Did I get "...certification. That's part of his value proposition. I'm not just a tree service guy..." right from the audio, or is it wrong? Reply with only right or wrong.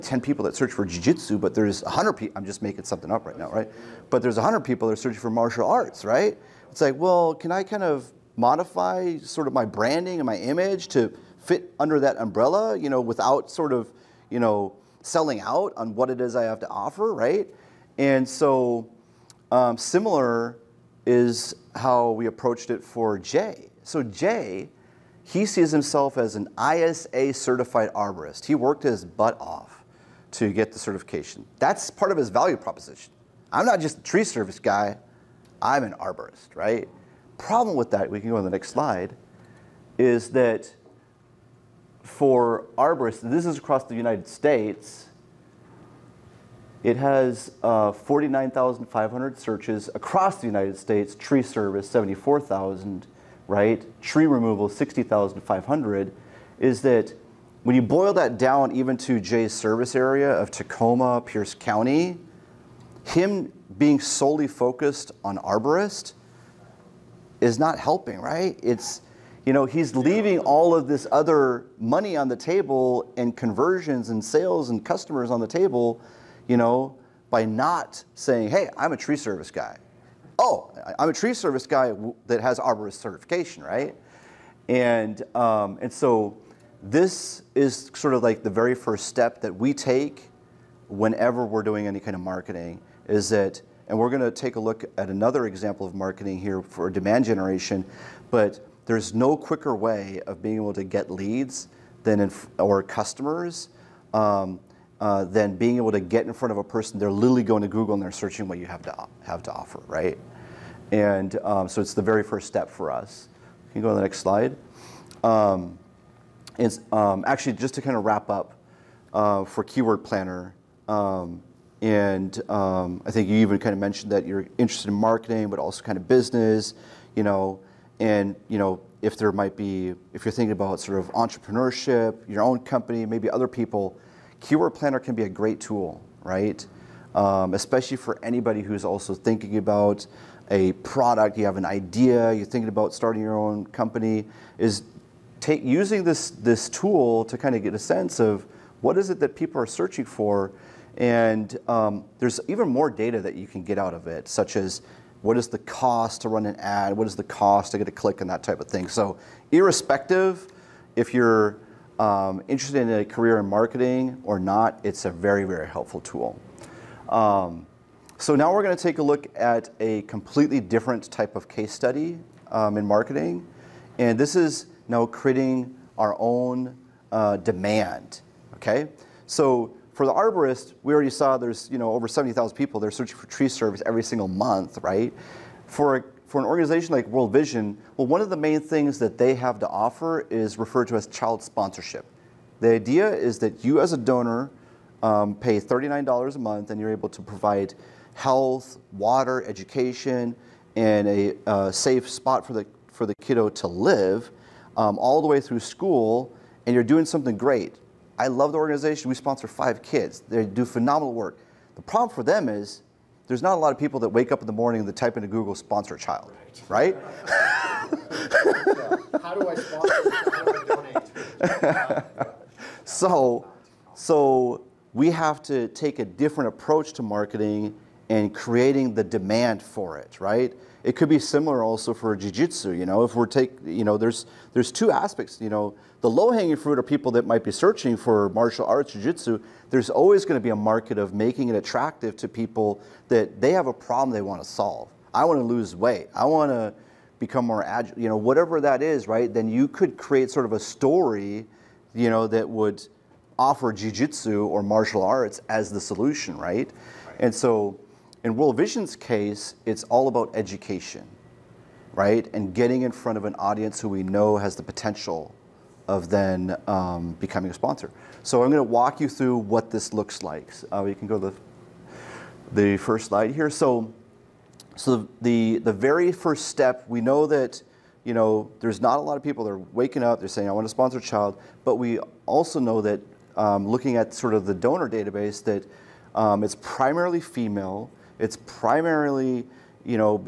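right.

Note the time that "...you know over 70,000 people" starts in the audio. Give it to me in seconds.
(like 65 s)
181 s.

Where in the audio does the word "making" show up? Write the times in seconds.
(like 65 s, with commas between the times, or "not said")
2 s, 241 s.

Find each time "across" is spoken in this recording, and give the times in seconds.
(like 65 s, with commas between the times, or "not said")
43 s, 49 s.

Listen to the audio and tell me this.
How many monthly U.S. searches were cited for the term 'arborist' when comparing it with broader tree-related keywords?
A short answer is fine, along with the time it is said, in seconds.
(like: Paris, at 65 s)
49,500, at 47 s.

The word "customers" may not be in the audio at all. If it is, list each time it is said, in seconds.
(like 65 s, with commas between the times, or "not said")
74 s, 102 s.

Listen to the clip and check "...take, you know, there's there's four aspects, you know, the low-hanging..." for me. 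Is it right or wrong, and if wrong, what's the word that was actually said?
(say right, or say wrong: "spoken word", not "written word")
wrong: "two", not "four".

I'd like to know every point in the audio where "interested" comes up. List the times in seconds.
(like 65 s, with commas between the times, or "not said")
124 s, 162 s.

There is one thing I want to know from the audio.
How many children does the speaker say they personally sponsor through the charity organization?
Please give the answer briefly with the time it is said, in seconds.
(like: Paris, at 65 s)
5, at 209 s.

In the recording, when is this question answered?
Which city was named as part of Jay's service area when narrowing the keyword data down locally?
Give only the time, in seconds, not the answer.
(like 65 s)
60 s.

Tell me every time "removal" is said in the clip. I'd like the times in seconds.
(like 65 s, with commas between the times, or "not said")
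54 s.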